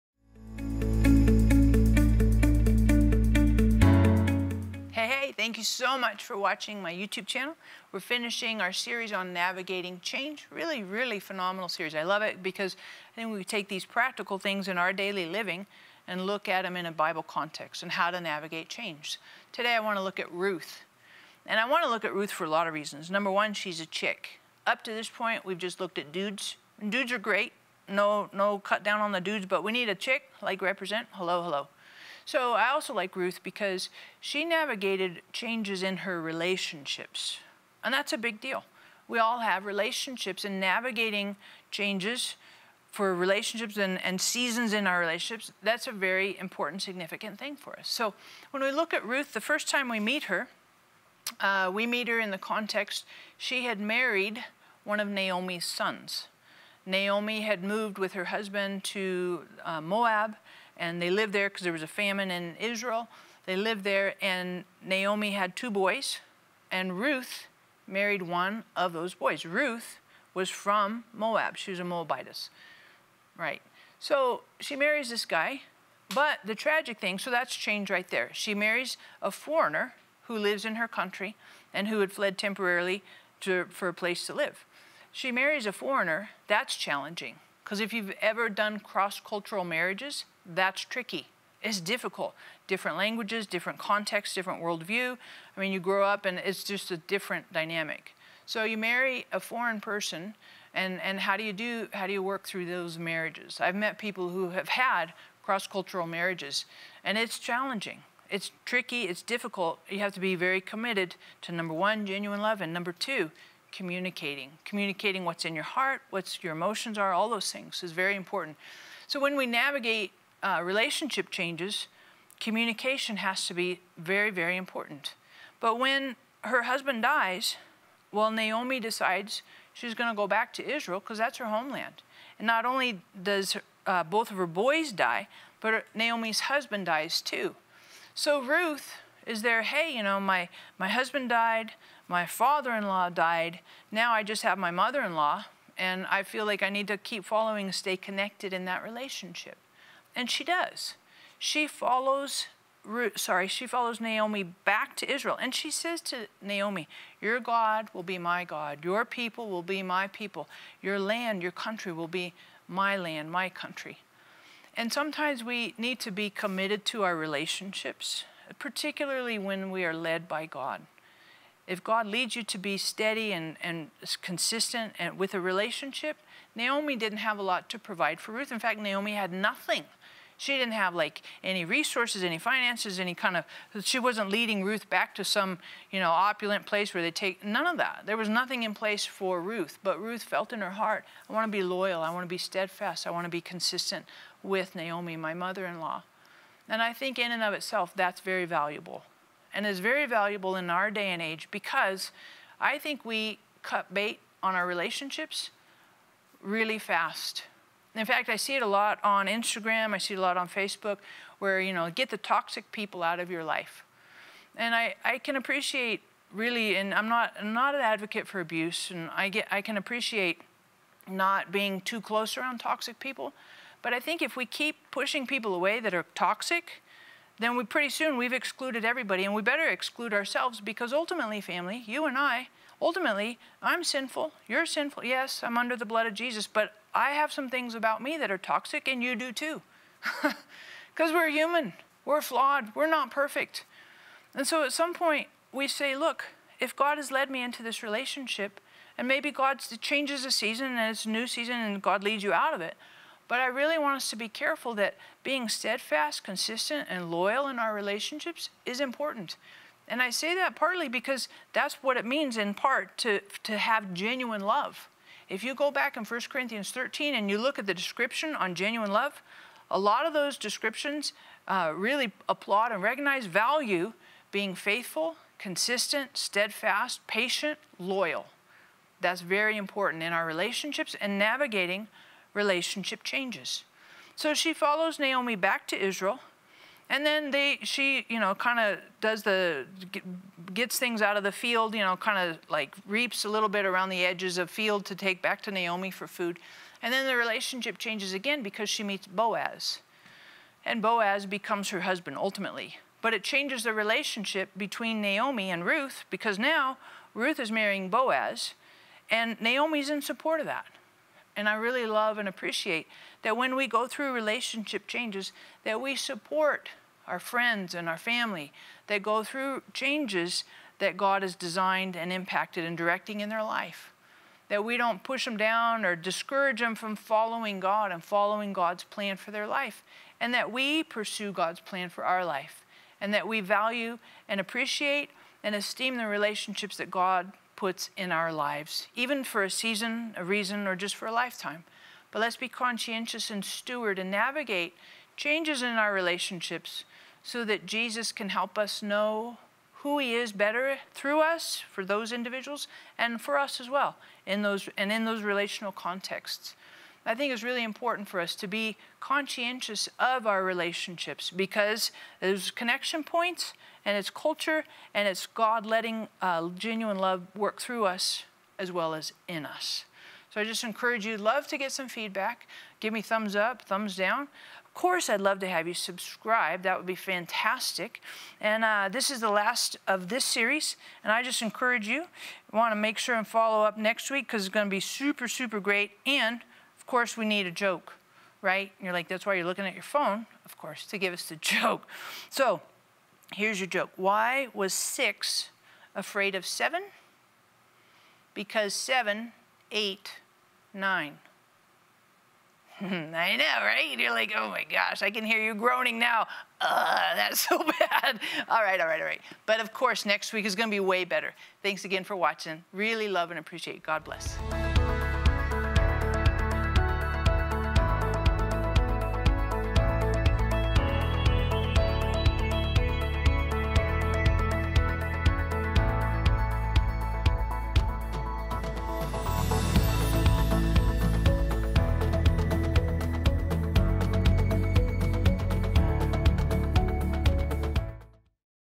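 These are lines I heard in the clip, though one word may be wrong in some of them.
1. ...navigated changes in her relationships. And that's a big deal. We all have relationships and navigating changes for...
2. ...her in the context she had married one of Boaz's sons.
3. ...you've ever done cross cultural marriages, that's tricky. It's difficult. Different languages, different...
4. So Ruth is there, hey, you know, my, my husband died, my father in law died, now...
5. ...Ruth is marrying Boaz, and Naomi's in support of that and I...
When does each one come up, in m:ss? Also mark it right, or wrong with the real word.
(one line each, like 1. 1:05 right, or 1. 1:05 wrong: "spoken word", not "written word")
1. 0:34 right
2. 0:52 wrong: "Naomi", not "Boaz"
3. 1:27 right
4. 2:18 right
5. 5:07 right.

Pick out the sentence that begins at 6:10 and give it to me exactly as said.
So I just encourage you, love to get some feedback.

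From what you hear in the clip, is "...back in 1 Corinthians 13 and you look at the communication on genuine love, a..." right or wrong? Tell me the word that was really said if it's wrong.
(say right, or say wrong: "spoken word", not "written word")
wrong: "description", not "communication".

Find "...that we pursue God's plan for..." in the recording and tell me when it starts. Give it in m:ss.
5:30.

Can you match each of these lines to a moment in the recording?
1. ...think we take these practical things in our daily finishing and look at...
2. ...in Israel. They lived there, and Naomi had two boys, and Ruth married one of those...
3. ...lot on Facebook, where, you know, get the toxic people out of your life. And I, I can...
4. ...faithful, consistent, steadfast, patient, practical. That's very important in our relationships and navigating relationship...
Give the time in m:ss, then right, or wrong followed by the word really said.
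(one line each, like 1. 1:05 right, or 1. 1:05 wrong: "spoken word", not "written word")
1. 0:13 wrong: "living", not "finishing"
2. 1:02 right
3. 3:30 right
4. 4:34 wrong: "loyal", not "practical".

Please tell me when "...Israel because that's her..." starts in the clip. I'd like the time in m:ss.
2:10.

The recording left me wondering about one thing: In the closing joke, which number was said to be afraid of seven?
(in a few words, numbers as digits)
6.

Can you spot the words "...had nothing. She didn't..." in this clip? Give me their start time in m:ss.
2:59.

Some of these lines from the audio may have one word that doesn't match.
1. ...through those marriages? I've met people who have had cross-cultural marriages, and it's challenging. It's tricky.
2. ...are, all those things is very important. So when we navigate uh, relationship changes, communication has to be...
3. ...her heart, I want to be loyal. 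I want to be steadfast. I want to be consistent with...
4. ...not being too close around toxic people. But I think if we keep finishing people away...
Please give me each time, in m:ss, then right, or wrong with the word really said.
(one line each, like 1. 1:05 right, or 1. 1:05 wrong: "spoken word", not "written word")
1. 1:42 right
2. 1:56 right
3. 3:10 right
4. 3:41 wrong: "pushing", not "finishing".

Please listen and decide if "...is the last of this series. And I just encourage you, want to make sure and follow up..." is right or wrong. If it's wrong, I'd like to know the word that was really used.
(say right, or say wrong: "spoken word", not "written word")
right.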